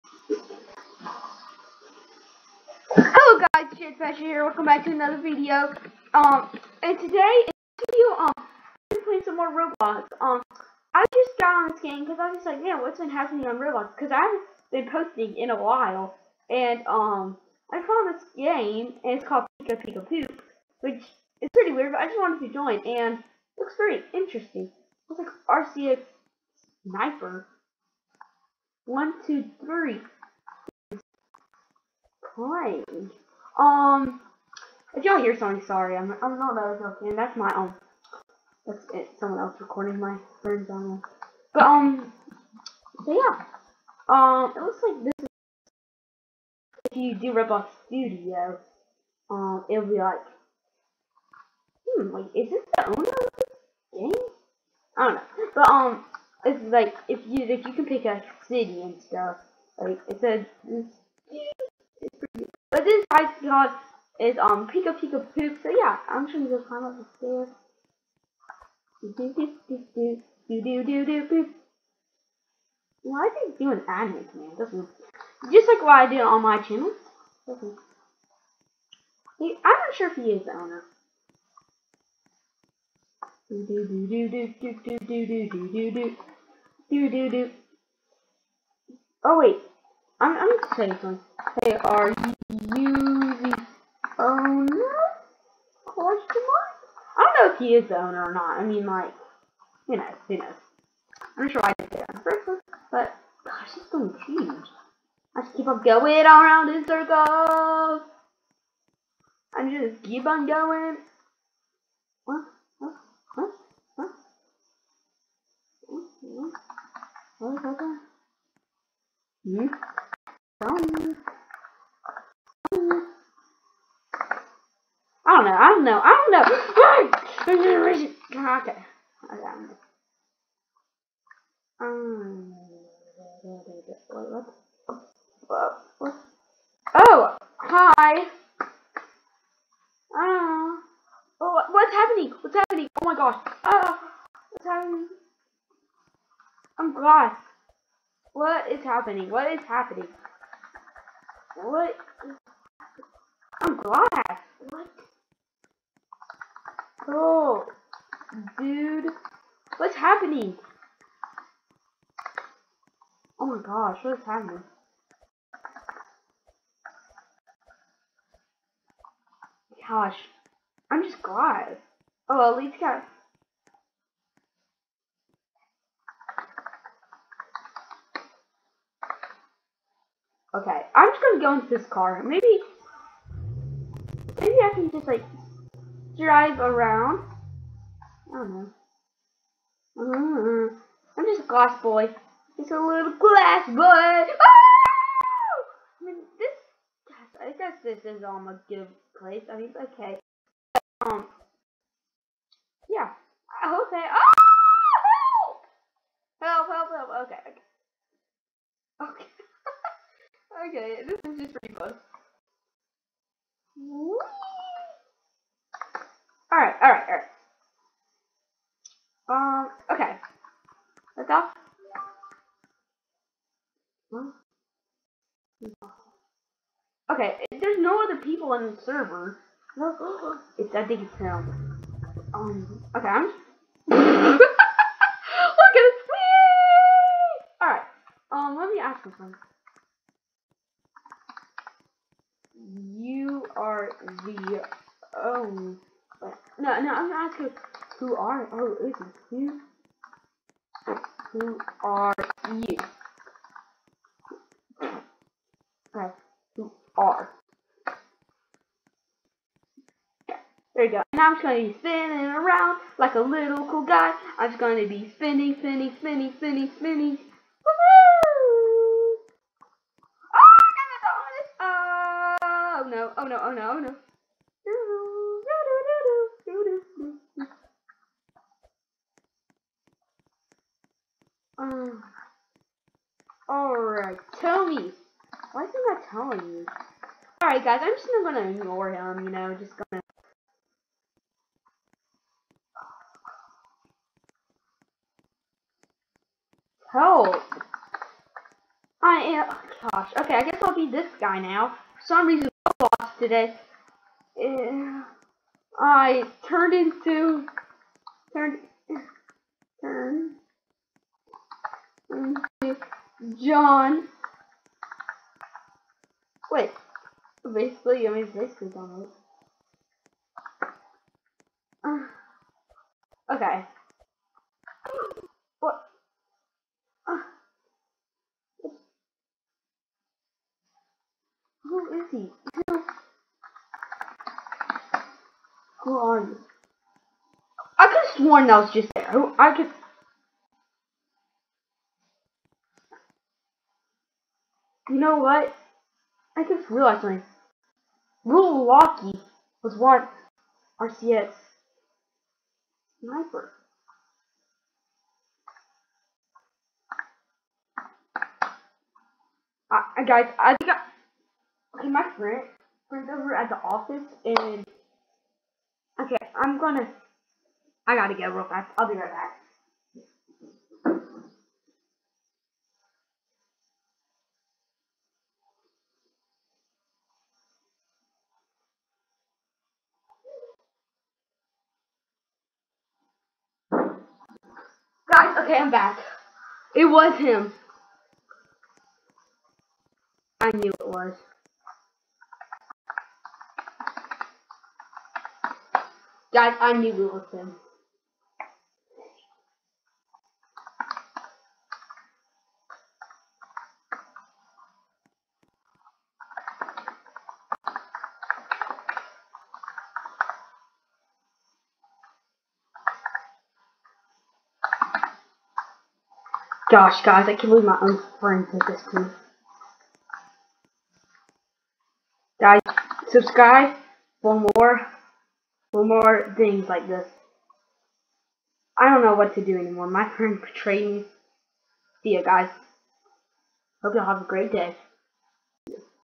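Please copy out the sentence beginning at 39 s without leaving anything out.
Someone else recording my friends on.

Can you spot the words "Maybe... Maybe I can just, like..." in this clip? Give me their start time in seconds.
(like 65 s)
182 s.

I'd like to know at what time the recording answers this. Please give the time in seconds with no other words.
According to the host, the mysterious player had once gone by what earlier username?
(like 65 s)
350 s.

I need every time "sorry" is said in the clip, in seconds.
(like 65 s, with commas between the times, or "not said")
35 s.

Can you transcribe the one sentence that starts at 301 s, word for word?
For some reason I lost today.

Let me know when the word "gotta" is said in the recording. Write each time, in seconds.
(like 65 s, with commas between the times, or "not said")
367 s.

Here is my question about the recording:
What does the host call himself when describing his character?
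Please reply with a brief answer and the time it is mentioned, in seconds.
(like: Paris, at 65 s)
little glass boy, at 192 s.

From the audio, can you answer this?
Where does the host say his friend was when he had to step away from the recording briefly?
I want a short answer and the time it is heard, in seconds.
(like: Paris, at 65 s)
the office, at 363 s.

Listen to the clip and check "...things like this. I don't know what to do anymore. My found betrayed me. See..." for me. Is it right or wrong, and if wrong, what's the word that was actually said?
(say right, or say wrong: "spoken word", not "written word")
wrong: "friend", not "found".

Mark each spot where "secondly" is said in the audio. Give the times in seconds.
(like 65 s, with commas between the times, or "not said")
not said.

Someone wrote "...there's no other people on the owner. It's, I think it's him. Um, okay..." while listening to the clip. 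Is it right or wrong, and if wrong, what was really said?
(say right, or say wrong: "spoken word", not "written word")
wrong: "server", not "owner".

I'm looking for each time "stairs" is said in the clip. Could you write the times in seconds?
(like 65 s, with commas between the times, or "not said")
67 s.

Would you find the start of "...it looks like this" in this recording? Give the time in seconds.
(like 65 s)
44 s.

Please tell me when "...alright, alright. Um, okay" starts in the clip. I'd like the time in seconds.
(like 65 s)
216 s.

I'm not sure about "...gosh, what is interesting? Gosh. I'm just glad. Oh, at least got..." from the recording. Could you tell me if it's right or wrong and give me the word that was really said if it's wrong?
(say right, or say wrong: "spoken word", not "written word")
wrong: "happening", not "interesting".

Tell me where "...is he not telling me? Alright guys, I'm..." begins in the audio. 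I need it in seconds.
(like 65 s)
285 s.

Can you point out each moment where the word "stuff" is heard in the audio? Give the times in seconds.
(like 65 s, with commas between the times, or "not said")
59 s.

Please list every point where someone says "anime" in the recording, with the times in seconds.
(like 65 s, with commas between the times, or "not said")
73 s.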